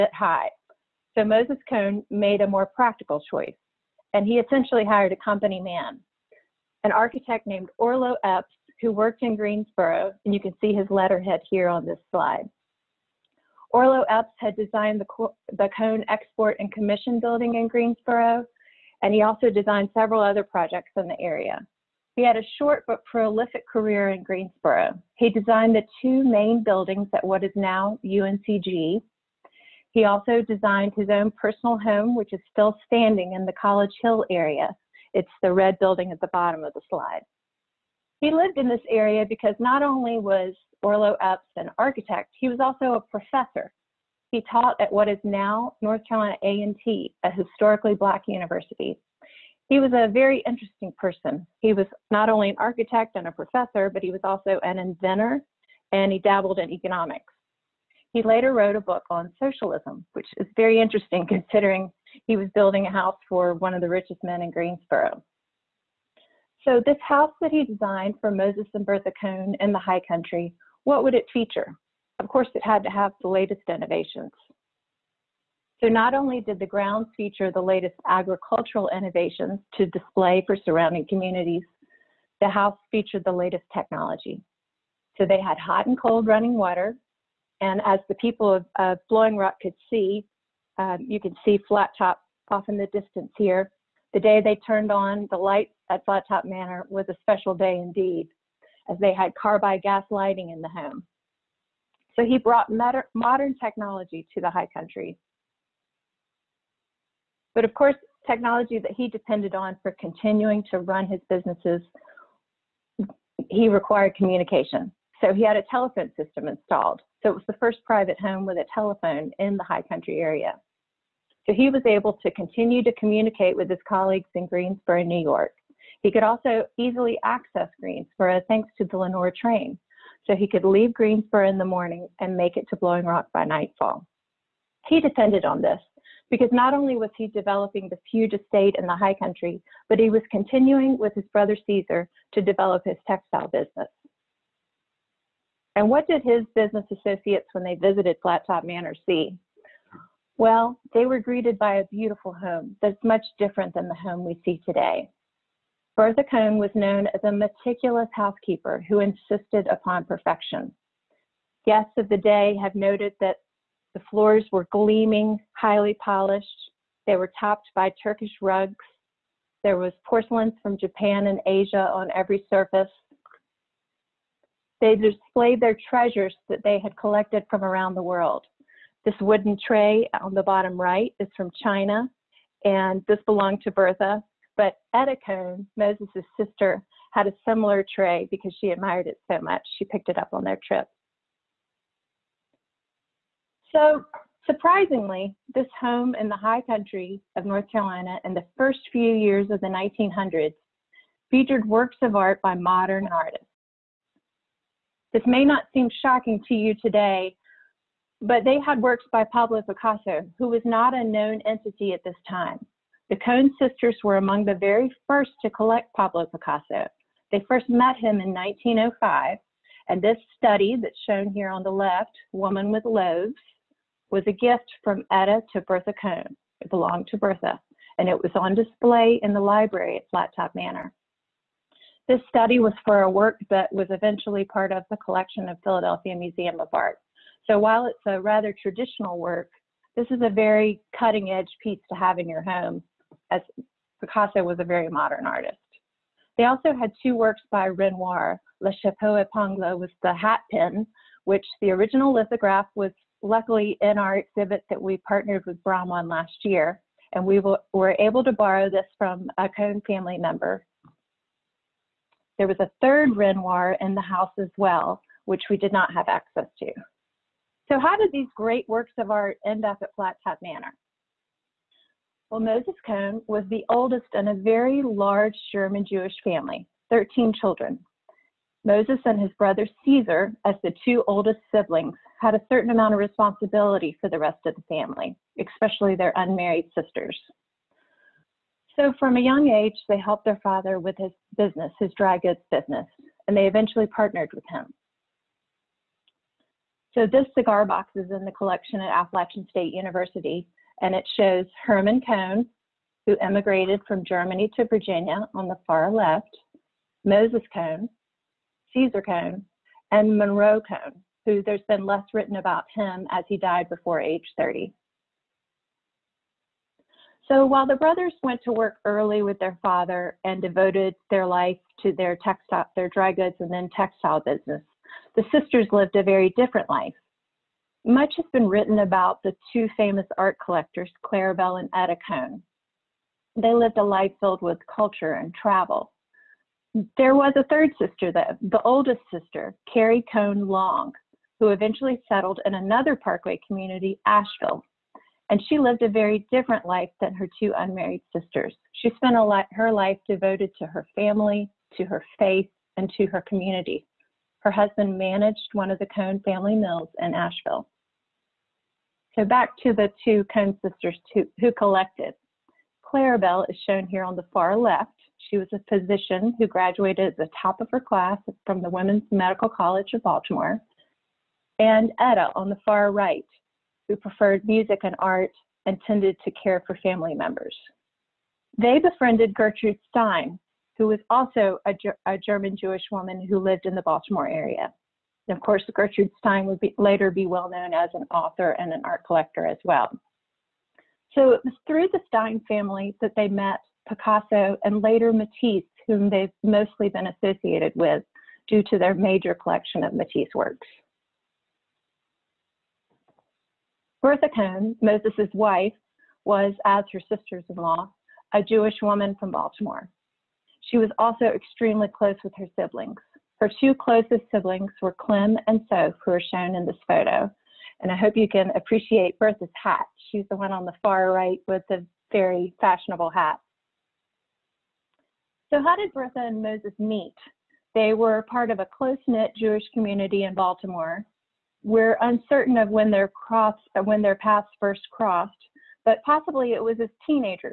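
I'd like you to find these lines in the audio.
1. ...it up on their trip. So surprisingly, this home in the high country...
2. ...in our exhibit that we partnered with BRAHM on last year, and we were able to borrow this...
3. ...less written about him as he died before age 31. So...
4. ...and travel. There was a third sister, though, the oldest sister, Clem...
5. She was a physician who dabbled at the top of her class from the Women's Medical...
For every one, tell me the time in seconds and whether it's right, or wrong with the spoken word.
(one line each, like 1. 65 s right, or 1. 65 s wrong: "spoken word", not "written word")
1. 190 s right
2. 253 s right
3. 311 s wrong: "30", not "31"
4. 335 s wrong: "Carrie", not "Clem"
5. 365 s wrong: "graduated", not "dabbled".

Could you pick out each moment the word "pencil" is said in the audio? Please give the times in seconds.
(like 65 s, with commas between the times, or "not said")
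not said.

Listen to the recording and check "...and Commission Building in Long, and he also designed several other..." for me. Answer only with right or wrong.
wrong.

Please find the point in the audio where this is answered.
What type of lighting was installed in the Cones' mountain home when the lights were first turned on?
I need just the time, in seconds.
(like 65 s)
99 s.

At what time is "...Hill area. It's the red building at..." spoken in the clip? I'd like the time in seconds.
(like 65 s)
34 s.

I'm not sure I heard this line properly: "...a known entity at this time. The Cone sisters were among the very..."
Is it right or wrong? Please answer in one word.
right.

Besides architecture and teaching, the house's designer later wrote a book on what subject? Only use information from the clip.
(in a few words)
socialism.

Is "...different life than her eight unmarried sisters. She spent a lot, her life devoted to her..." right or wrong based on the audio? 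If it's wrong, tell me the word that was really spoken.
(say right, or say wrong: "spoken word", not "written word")
wrong: "two", not "eight".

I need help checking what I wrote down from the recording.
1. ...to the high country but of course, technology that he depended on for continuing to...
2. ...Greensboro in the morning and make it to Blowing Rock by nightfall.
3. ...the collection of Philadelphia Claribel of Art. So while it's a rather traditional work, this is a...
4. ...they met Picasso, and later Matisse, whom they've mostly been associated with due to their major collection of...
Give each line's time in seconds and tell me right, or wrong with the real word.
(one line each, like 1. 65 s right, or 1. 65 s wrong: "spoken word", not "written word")
1. 104 s right
2. 130 s right
3. 234 s wrong: "Museum", not "Claribel"
4. 393 s right.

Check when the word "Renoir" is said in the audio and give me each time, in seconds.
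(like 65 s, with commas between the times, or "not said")
247 s, 263 s.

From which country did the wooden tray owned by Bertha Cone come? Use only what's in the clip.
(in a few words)
China.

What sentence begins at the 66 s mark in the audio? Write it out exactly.
So, this house that he designed for Moses and Bertha Cone in the high country, what would it feature?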